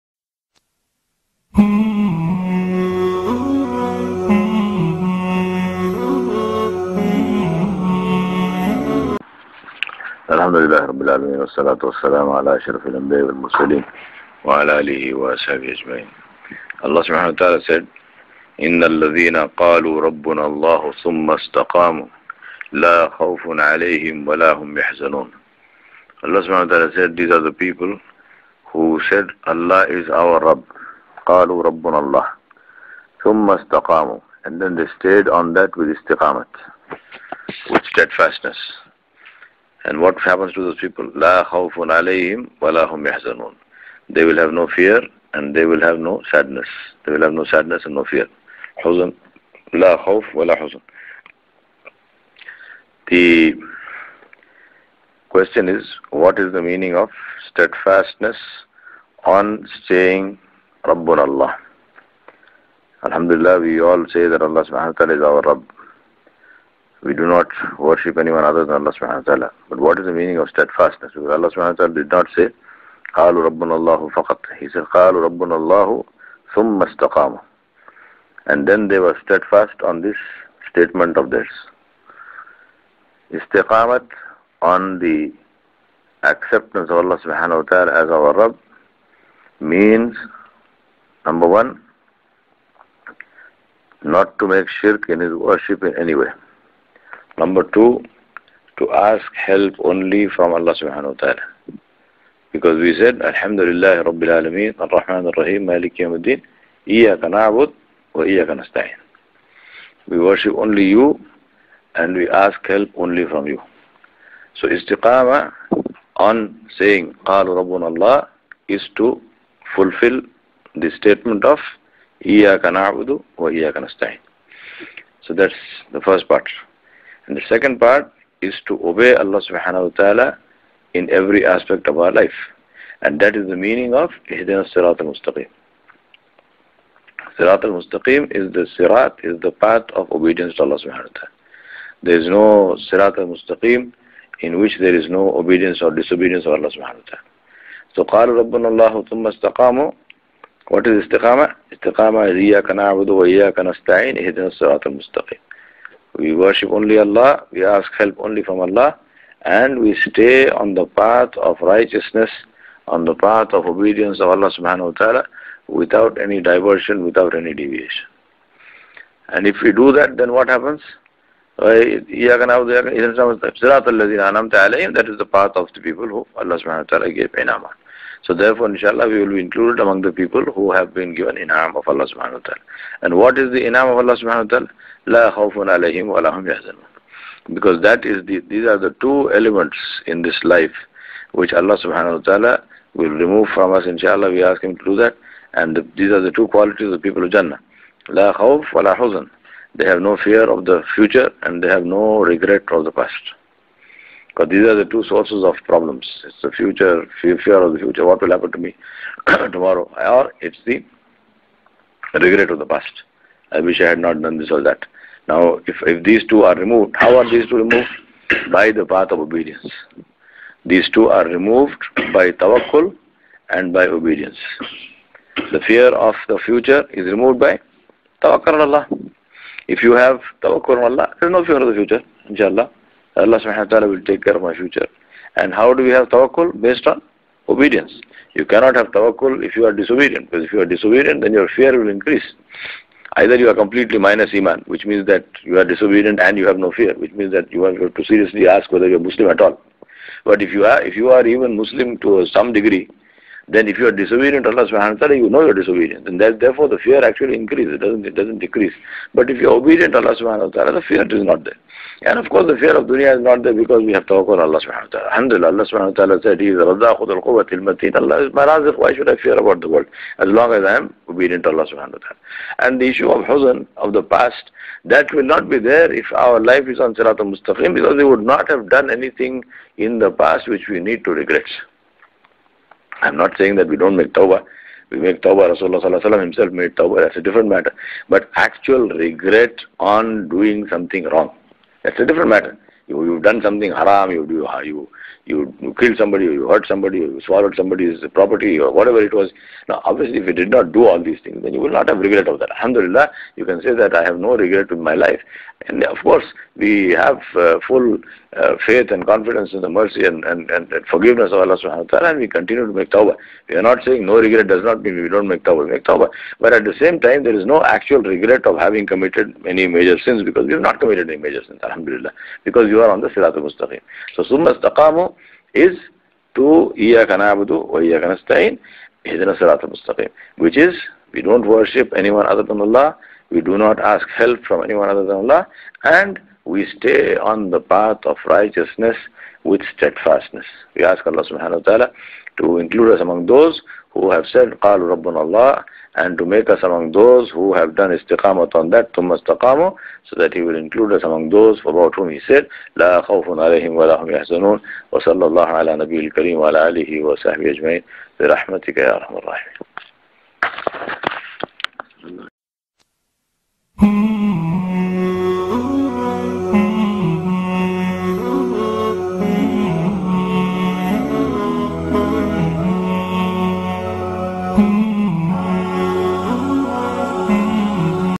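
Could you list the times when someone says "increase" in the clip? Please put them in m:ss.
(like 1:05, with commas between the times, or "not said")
4:01, 4:17.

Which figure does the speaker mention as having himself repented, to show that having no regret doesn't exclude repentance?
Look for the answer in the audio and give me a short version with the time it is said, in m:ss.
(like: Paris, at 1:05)
Rasulullah, at 4:45.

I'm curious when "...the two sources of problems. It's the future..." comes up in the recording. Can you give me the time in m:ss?
3:24.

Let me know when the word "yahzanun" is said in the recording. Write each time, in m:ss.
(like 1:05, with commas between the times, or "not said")
0:43, 3:06.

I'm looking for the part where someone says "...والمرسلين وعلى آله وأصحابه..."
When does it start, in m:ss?
0:13.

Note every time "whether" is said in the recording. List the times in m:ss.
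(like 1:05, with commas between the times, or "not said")
4:08.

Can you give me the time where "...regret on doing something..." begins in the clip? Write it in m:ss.
4:48.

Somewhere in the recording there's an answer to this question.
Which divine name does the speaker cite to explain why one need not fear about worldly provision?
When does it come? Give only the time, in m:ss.
4:26.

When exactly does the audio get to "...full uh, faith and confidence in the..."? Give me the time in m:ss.
5:07.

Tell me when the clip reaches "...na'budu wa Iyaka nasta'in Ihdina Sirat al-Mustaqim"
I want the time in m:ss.
5:27.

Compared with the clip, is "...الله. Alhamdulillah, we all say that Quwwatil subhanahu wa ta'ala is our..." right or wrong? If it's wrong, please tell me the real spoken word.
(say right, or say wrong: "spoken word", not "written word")
wrong: "Allah", not "Quwwatil".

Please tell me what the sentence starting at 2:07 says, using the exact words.
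And the second part is to obey Allah subhanahu wa ta'ala in every aspect of our life.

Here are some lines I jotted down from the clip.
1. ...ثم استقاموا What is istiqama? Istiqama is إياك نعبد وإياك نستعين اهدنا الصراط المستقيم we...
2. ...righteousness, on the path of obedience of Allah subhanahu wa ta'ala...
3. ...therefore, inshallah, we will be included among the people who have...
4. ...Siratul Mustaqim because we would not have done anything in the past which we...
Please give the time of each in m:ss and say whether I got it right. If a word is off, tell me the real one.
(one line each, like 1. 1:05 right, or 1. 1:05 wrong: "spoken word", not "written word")
1. 2:29 right
2. 2:41 right
3. 2:58 right
4. 4:36 right.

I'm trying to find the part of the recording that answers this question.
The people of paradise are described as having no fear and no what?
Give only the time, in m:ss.
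3:18.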